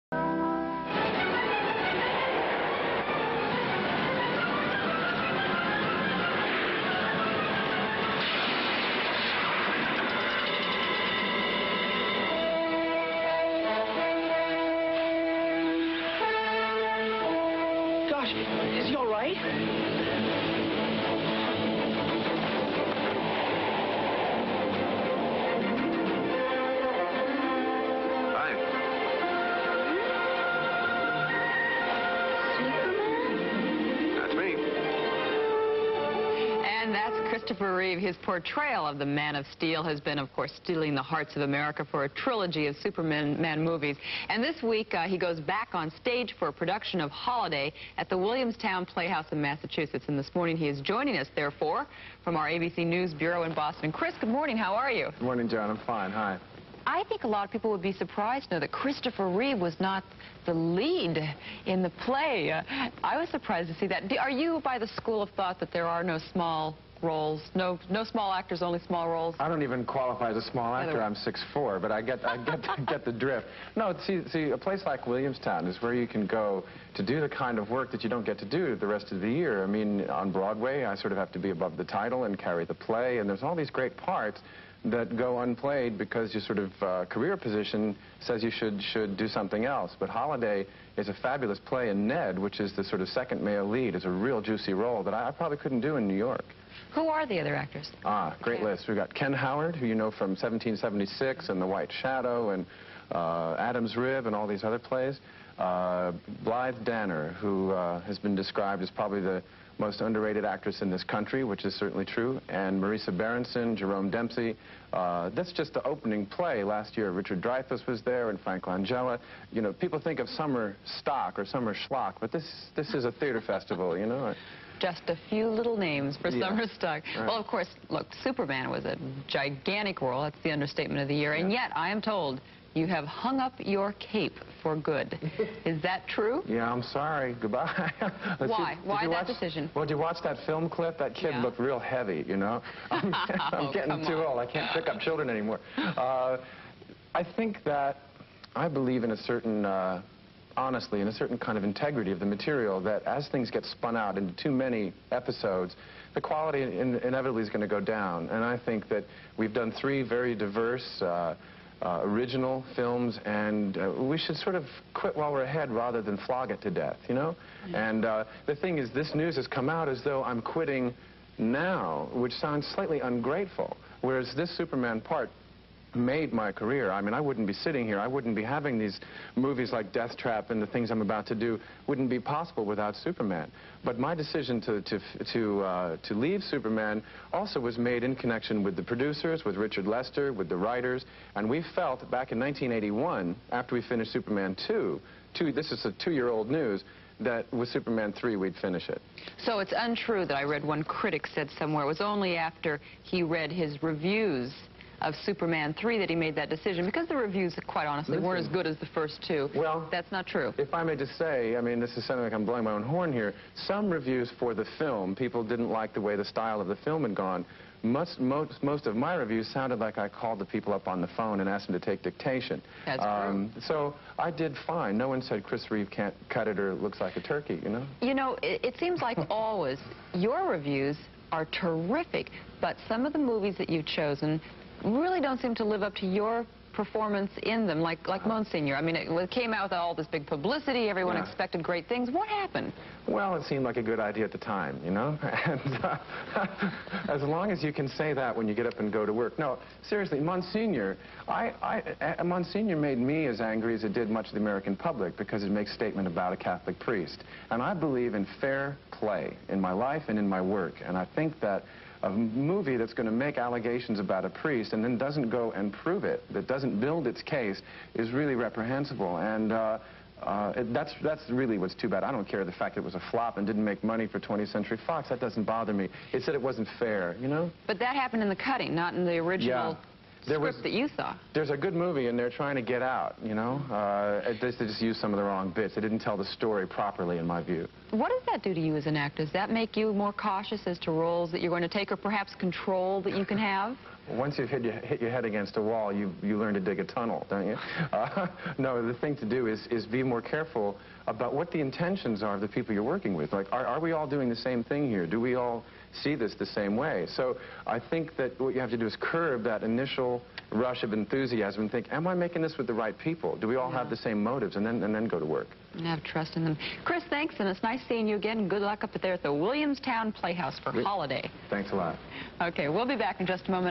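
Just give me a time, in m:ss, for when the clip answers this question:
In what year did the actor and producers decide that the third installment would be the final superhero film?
3:12.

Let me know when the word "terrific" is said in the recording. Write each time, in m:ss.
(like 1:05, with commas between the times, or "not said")
3:51.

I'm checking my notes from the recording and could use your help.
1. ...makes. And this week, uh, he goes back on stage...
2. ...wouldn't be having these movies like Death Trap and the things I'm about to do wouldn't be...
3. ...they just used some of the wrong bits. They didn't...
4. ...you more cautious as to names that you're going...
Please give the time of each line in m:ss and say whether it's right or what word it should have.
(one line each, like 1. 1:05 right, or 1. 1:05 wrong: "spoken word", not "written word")
1. 0:43 wrong: "movies", not "makes"
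2. 2:58 right
3. 4:44 right
4. 4:49 wrong: "roles", not "names".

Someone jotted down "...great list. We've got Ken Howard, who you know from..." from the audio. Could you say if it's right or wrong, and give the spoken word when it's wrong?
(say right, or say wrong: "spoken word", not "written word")
right.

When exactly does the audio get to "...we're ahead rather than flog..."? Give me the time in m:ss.
2:45.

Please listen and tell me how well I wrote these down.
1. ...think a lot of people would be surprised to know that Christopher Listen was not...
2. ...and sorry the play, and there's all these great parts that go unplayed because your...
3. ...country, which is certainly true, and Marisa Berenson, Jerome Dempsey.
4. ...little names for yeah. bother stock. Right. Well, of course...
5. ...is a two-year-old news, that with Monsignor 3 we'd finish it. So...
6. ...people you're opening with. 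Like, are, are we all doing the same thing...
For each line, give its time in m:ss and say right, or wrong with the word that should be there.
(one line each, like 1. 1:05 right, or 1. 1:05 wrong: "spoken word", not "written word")
1. 0:57 wrong: "Reeve", not "Listen"
2. 1:22 wrong: "carry", not "sorry"
3. 1:51 right
4. 2:05 wrong: "summer", not "bother"
5. 3:15 wrong: "Superman", not "Monsignor"
6. 5:02 wrong: "working", not "opening".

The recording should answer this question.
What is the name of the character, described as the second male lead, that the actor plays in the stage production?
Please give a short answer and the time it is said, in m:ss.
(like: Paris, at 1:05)
Ned, at 1:32.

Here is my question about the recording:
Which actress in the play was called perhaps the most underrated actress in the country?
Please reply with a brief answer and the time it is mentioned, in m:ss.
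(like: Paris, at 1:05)
Blythe Danner, at 1:46.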